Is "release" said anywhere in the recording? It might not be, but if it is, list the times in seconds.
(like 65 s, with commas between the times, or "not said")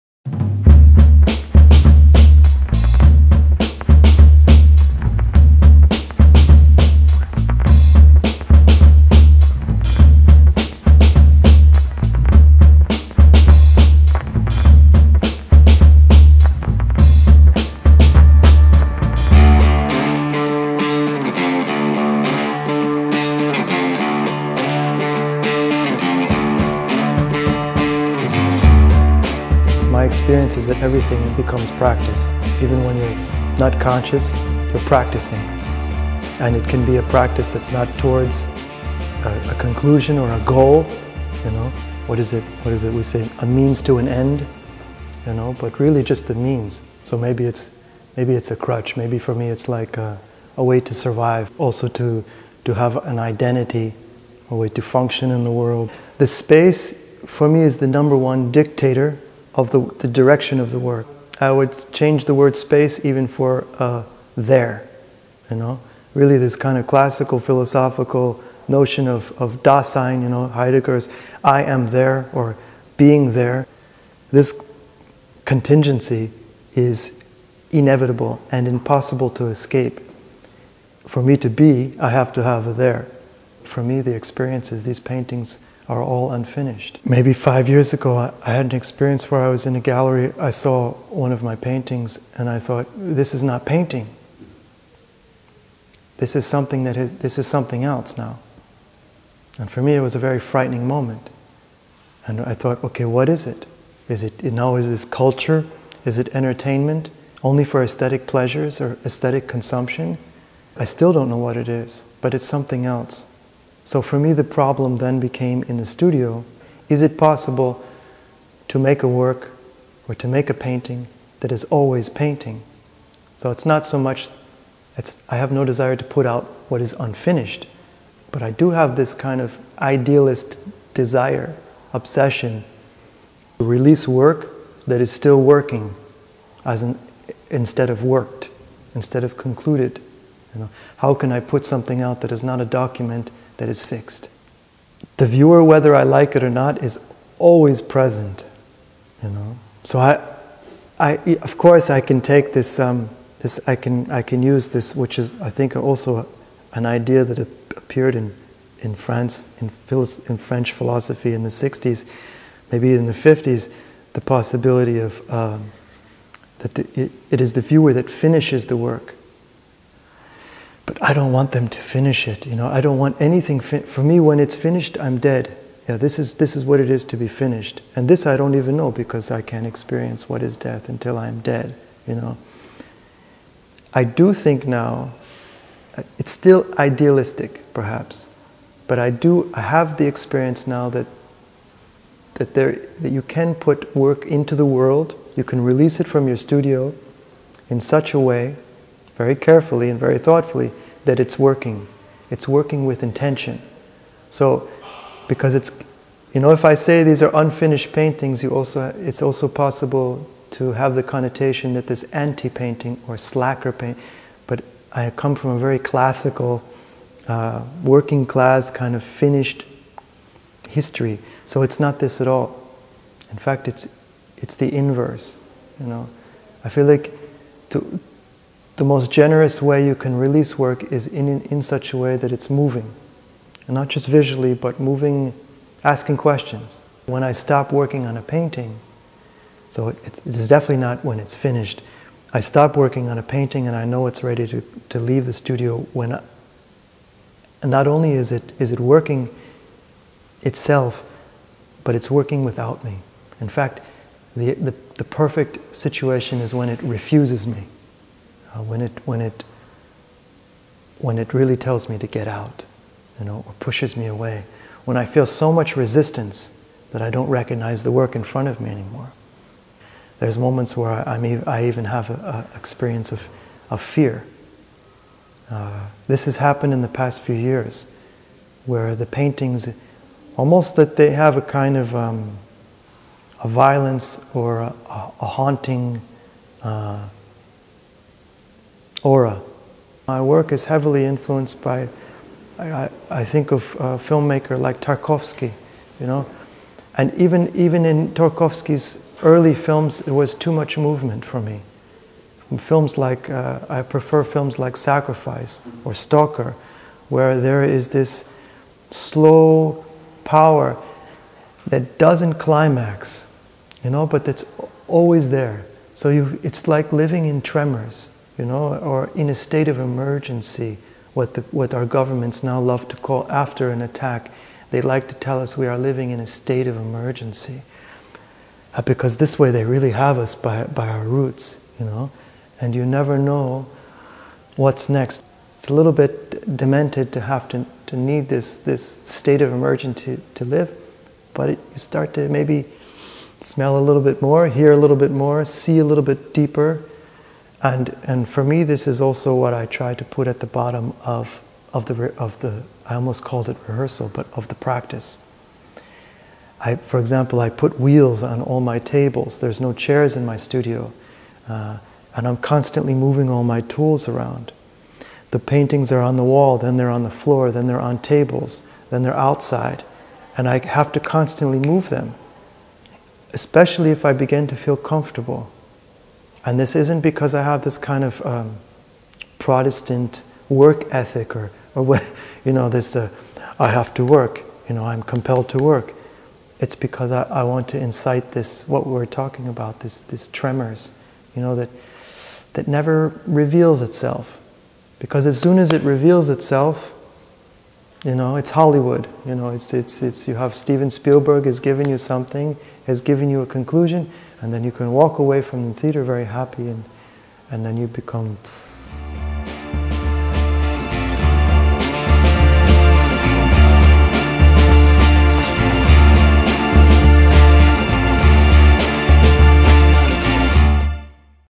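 133 s, 195 s, 230 s.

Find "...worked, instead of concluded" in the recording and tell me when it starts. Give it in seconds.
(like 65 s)
138 s.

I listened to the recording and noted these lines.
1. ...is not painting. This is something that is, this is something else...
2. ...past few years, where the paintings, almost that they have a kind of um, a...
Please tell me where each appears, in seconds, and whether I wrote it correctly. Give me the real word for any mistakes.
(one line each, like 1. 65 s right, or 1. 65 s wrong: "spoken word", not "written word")
1. 93 s right
2. 276 s right.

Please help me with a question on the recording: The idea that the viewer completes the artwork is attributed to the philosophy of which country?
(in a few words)
France.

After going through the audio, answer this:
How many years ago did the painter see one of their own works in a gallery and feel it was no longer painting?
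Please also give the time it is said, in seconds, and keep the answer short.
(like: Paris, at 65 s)
5, at 87 s.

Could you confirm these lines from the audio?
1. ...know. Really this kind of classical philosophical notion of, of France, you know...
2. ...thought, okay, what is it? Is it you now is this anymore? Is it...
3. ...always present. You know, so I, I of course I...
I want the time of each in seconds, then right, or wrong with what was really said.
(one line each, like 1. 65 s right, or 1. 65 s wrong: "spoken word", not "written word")
1. 65 s wrong: "Dasein", not "France"
2. 102 s wrong: "culture", not "anymore"
3. 147 s right.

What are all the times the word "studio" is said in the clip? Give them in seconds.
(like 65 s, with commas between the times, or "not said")
115 s, 196 s, 245 s, 360 s.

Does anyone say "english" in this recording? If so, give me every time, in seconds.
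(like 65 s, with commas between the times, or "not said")
not said.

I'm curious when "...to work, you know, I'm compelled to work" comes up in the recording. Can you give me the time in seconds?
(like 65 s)
383 s.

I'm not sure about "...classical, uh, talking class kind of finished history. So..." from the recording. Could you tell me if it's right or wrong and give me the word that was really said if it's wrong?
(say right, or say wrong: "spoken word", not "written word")
wrong: "working", not "talking".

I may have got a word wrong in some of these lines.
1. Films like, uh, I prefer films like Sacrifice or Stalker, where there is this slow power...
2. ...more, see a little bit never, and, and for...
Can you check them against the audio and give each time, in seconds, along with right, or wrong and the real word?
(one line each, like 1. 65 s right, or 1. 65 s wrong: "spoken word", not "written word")
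1. 302 s right
2. 345 s wrong: "deeper", not "never".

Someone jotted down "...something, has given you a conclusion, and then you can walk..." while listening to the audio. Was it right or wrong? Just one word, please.
right.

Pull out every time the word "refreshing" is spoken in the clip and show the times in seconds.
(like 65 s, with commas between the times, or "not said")
not said.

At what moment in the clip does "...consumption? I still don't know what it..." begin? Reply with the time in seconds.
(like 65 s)
109 s.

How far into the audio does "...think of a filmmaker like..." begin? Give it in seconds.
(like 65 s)
293 s.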